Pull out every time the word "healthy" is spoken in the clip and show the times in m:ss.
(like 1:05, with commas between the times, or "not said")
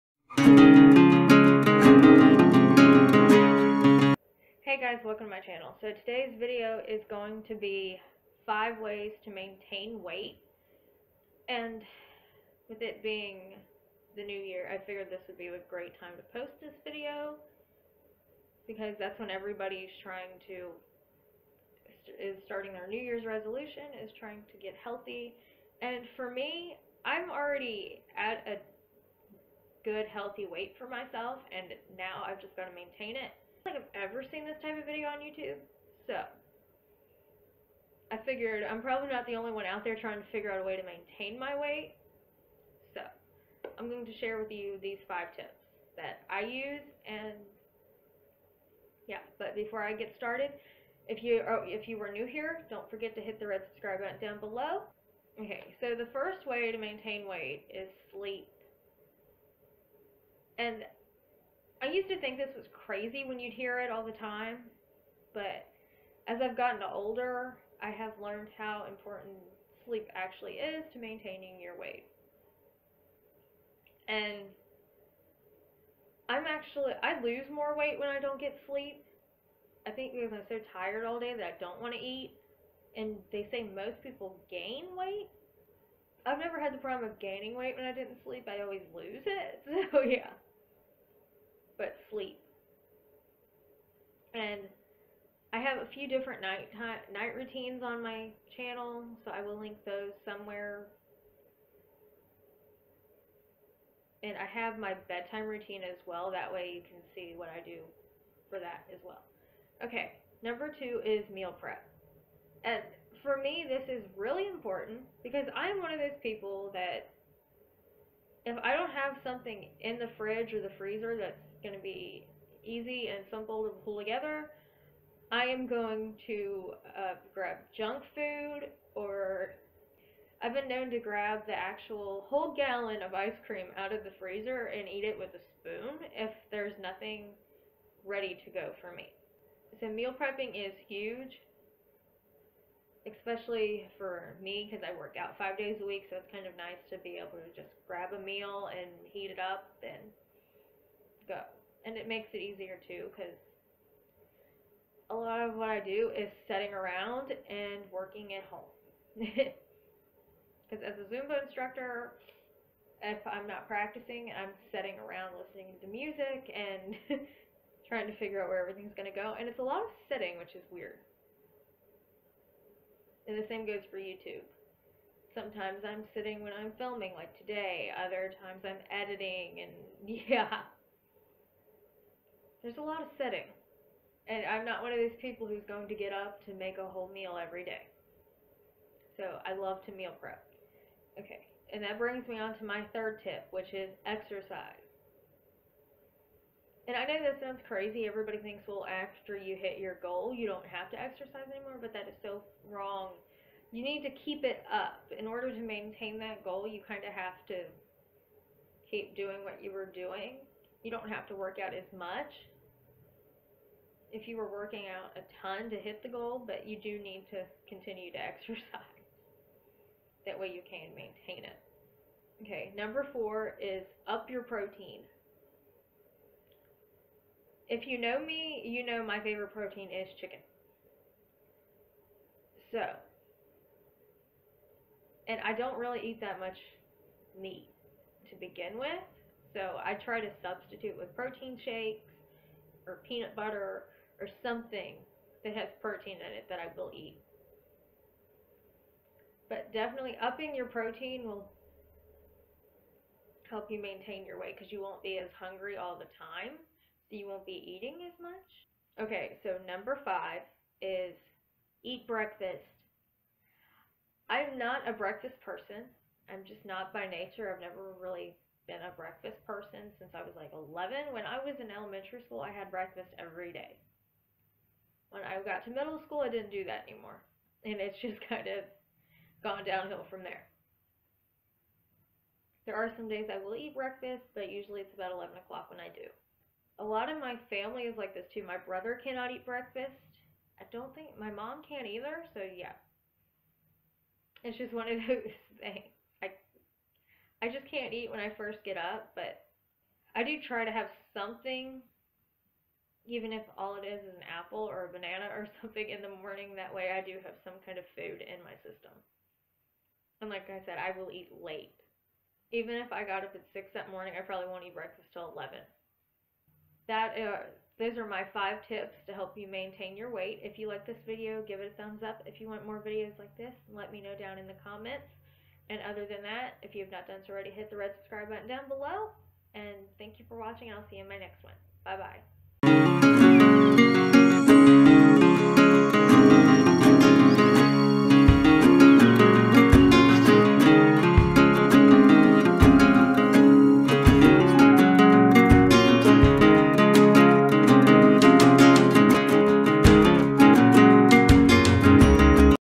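0:24, 0:30.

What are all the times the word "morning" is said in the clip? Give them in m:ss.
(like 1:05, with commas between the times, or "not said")
5:06, 5:13.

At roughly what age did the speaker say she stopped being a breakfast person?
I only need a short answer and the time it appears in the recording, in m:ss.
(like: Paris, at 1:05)
11, at 4:30.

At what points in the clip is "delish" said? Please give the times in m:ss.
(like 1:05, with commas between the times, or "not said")
not said.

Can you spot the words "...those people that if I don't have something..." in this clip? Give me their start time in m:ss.
1:55.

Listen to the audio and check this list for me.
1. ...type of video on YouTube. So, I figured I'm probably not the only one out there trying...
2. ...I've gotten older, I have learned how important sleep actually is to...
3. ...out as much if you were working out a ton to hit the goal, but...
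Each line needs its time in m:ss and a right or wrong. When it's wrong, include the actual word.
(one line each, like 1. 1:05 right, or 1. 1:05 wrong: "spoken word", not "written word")
1. 0:34 right
2. 1:06 right
3. 3:31 right.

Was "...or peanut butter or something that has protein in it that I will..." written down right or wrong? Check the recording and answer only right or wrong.
right.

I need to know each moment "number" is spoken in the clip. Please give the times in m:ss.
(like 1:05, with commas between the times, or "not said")
1:50, 3:42, 4:19.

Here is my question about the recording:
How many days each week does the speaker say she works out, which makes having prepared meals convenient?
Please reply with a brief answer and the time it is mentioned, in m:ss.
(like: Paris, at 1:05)
5, at 2:25.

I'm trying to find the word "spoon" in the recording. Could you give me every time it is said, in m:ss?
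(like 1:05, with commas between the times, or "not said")
2:15.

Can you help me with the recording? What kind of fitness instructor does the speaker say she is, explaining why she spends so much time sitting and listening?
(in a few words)
Zumba.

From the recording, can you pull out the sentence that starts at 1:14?
And I'm actually, I lose more weight when I don't get sleep.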